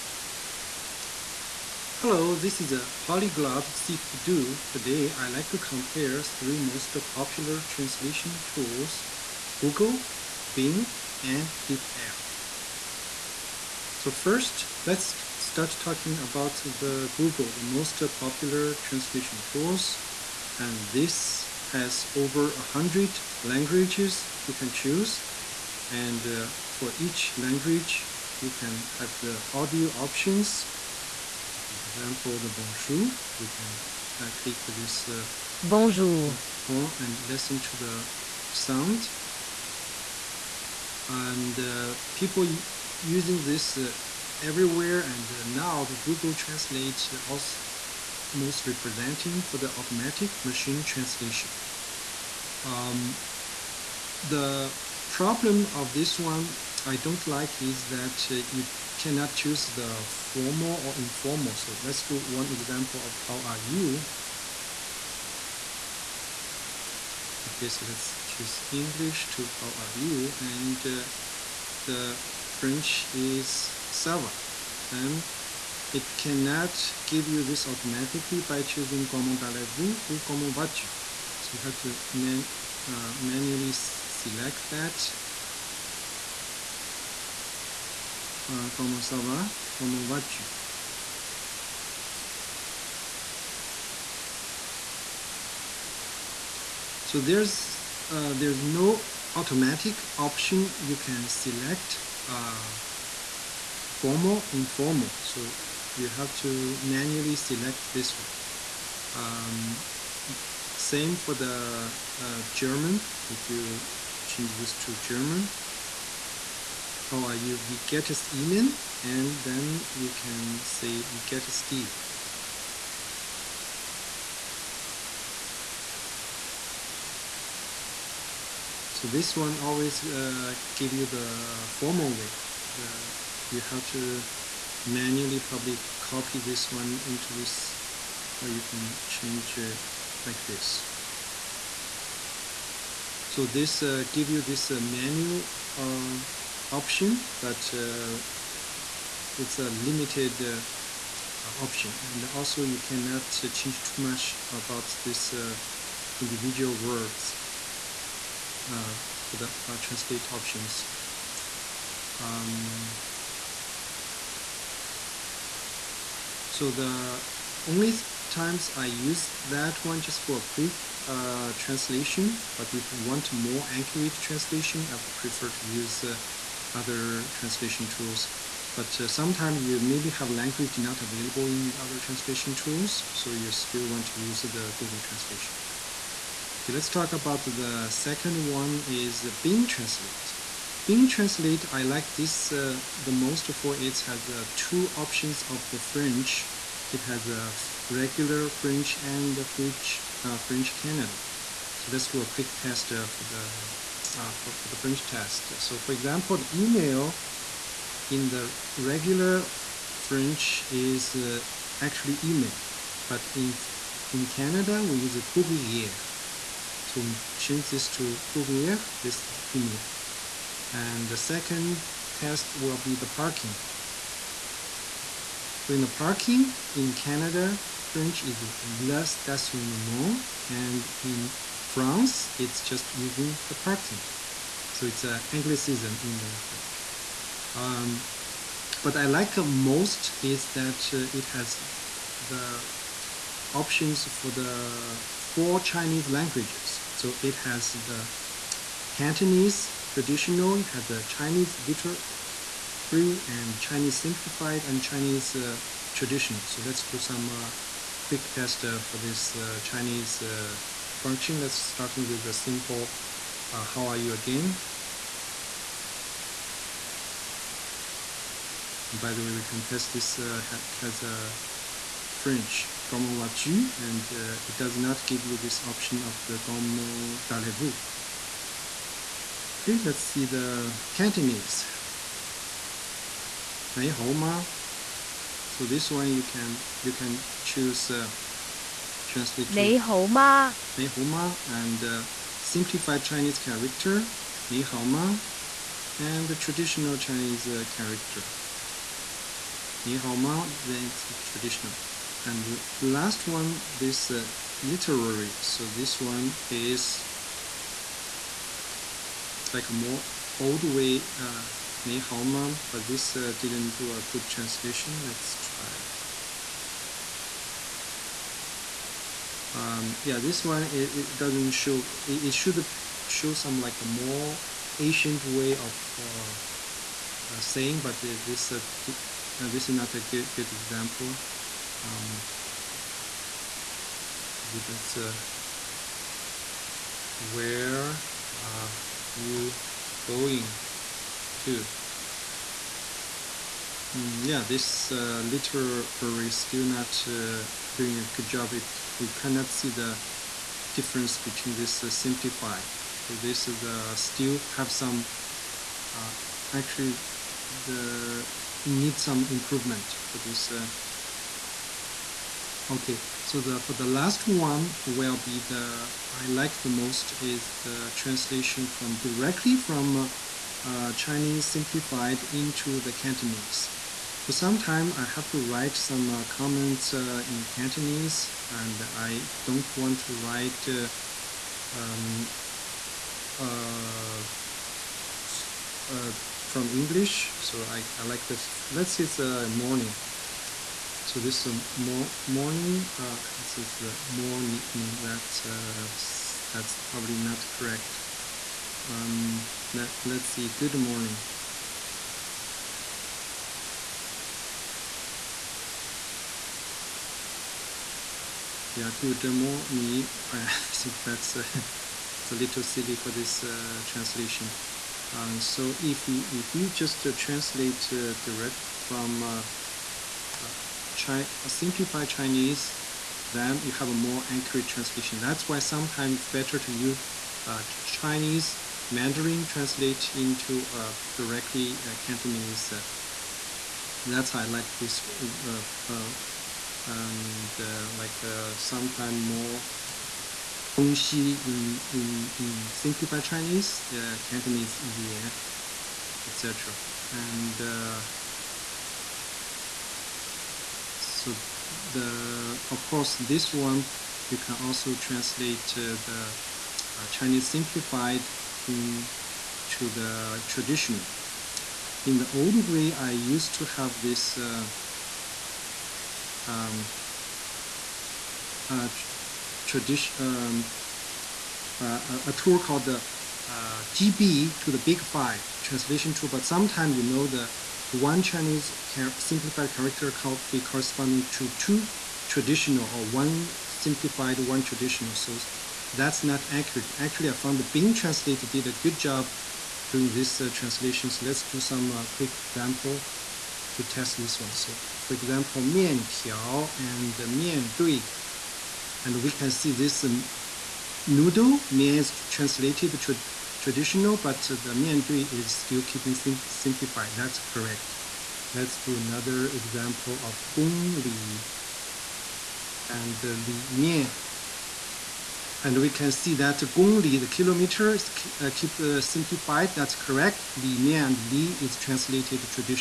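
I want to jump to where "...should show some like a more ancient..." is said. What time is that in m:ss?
5:22.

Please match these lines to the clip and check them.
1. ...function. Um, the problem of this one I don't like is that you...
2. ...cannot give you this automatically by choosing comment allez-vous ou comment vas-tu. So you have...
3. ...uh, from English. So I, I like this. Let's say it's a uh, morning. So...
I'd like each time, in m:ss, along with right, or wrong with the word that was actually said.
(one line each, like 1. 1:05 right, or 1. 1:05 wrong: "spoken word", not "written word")
1. 0:50 wrong: "translation", not "function"
2. 1:16 right
3. 6:25 right.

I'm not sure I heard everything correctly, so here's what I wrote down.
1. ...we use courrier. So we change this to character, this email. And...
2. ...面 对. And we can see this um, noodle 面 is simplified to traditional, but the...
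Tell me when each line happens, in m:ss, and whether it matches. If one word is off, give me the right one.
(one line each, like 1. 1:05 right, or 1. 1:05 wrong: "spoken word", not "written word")
1. 3:34 wrong: "courrier", not "character"
2. 8:17 wrong: "translated", not "simplified".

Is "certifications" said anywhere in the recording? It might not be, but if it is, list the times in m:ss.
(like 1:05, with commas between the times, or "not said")
not said.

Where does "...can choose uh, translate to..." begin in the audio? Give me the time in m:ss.
4:46.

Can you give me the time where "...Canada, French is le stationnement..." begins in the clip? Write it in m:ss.
3:46.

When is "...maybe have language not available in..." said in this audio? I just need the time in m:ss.
2:59.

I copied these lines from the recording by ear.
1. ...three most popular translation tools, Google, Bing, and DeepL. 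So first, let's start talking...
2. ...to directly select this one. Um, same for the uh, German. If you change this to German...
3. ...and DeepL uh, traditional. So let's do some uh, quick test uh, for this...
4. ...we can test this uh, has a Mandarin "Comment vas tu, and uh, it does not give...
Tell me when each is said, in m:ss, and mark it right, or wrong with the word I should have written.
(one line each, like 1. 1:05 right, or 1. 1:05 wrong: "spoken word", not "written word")
1. 0:06 right
2. 1:46 wrong: "manually", not "directly"
3. 4:14 wrong: "Chinese", not "DeepL"
4. 4:29 wrong: "French", not "Mandarin".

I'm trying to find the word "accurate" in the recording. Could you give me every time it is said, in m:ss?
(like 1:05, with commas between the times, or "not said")
2:53, 7:04, 8:06.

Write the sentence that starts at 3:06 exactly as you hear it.
Okay, let's talk about the second one is the Bing Translate.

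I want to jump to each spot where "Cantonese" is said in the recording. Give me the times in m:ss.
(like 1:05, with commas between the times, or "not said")
4:08, 4:40, 6:12, 6:17, 7:11, 7:24.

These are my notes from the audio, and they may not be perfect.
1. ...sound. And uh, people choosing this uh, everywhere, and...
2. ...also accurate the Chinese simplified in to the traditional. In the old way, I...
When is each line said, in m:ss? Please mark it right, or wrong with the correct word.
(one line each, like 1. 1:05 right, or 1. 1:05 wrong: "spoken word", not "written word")
1. 0:38 wrong: "using", not "choosing"
2. 7:34 wrong: "translate", not "accurate".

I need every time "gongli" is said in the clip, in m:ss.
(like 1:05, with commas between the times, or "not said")
8:36.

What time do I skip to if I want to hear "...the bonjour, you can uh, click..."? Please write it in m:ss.
0:32.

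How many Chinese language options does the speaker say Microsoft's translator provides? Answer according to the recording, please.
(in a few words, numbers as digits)
4.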